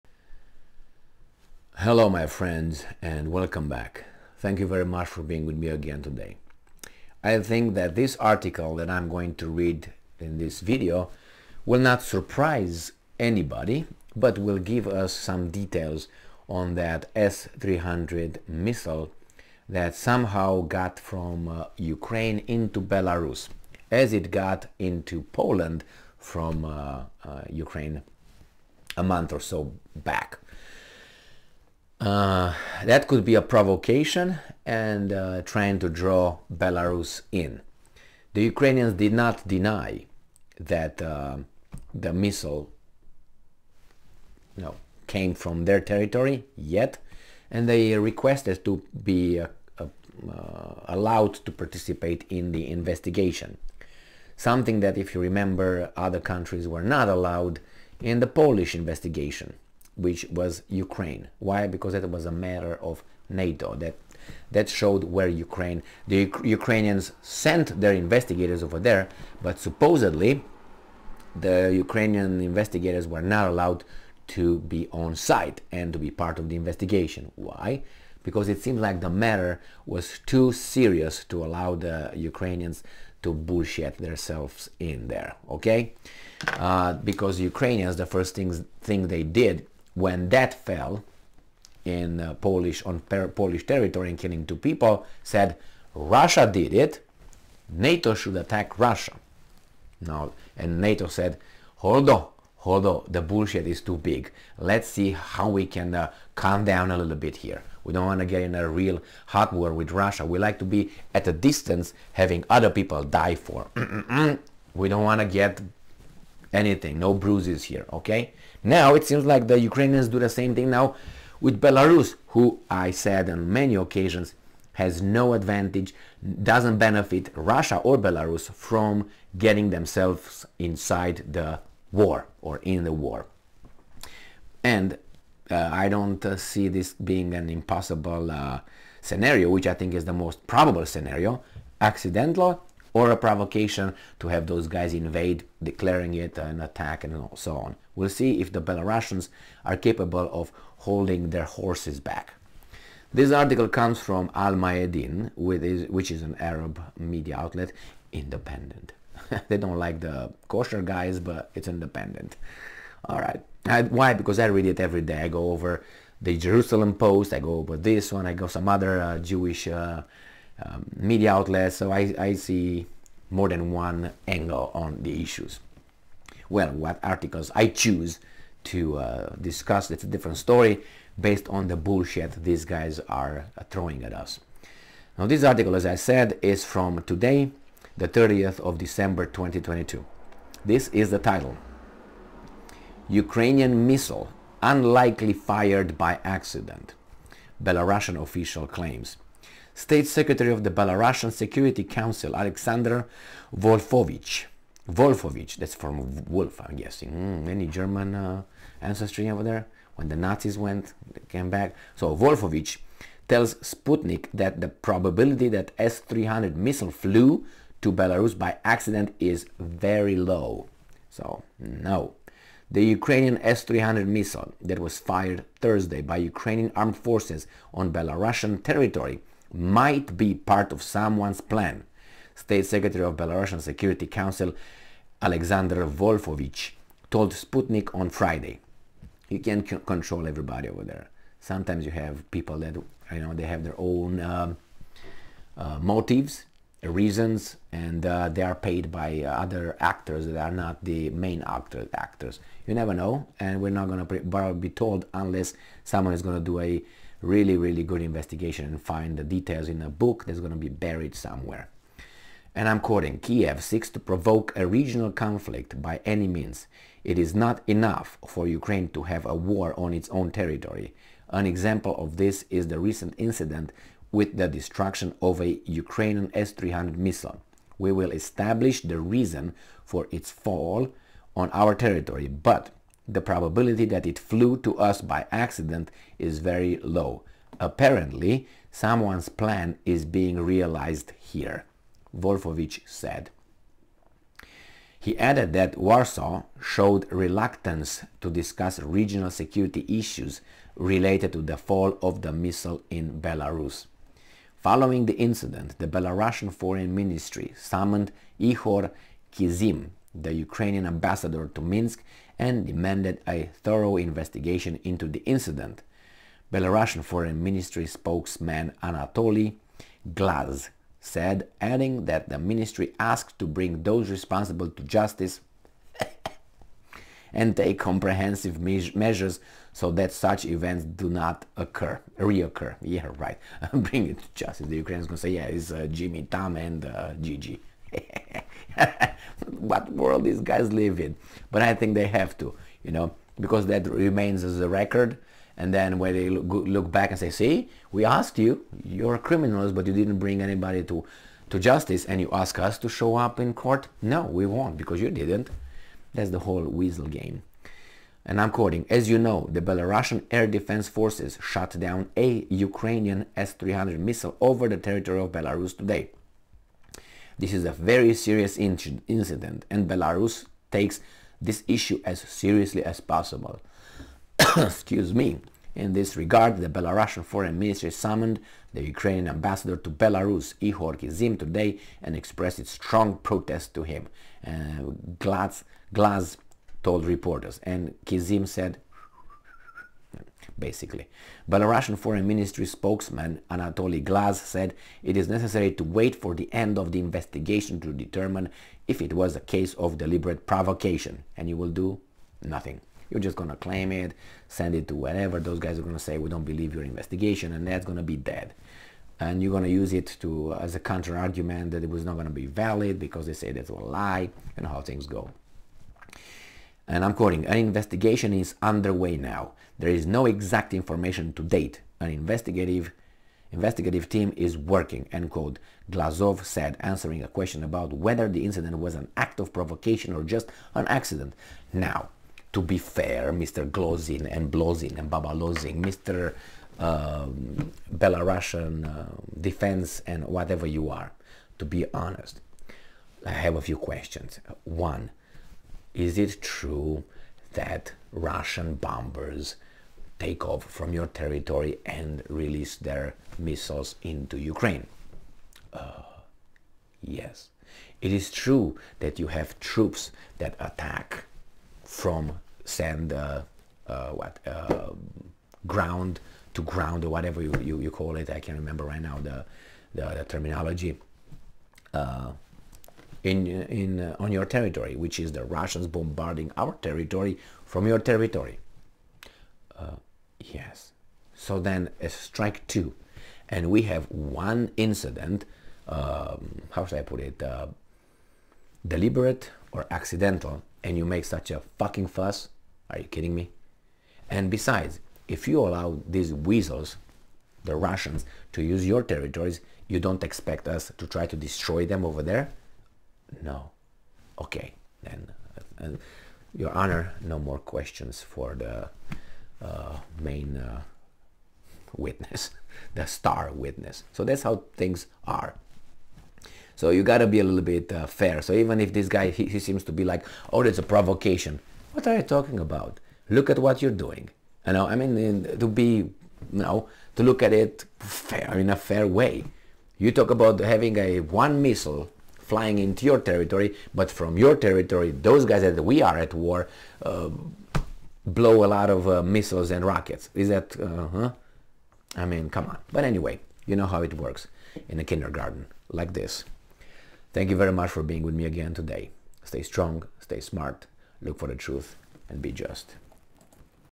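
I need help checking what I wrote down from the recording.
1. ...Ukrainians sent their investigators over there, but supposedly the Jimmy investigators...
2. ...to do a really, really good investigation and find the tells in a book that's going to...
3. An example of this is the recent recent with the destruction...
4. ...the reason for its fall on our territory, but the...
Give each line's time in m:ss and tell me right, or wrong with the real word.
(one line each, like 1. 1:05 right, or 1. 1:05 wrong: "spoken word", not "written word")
1. 1:06 wrong: "Ukrainian", not "Jimmy"
2. 4:16 wrong: "details", not "tells"
3. 4:31 wrong: "incident", not "recent"
4. 4:38 right.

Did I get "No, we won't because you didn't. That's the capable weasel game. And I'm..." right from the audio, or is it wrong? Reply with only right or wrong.
wrong.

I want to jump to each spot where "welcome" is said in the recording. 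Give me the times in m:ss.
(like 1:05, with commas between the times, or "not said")
0:03.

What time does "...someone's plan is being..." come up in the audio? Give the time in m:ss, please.
4:48.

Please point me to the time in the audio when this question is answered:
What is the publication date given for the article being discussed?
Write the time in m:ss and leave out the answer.
3:08.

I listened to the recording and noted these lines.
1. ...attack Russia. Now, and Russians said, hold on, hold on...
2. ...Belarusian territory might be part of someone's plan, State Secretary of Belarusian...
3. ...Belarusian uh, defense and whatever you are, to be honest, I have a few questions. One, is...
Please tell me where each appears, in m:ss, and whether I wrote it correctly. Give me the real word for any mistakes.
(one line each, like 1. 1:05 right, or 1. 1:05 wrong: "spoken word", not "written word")
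1. 1:38 wrong: "NATO", not "Russians"
2. 3:47 right
3. 7:17 right.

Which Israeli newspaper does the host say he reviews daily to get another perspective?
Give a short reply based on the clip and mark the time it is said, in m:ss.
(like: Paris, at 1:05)
Jerusalem Post, at 2:46.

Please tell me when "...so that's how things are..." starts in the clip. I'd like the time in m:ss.
8:34.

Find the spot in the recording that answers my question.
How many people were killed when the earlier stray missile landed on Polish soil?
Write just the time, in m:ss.
1:34.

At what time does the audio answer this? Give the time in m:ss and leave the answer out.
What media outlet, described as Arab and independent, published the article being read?
2:34.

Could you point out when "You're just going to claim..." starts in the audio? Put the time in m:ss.
6:43.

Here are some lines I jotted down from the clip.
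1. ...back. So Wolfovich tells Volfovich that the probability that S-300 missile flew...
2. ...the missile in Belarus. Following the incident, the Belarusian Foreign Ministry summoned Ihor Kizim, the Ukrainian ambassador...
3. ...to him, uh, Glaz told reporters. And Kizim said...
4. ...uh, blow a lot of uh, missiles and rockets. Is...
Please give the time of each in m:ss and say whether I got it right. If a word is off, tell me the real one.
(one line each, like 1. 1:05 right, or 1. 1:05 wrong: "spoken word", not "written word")
1. 3:31 wrong: "Sputnik", not "Volfovich"
2. 5:02 right
3. 6:23 right
4. 8:57 right.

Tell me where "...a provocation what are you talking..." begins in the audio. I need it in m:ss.
8:40.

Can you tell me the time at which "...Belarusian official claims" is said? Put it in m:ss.
3:17.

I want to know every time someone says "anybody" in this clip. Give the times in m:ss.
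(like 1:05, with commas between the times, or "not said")
0:13, 5:50.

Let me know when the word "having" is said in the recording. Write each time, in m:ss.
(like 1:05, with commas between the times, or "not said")
1:52, 8:50.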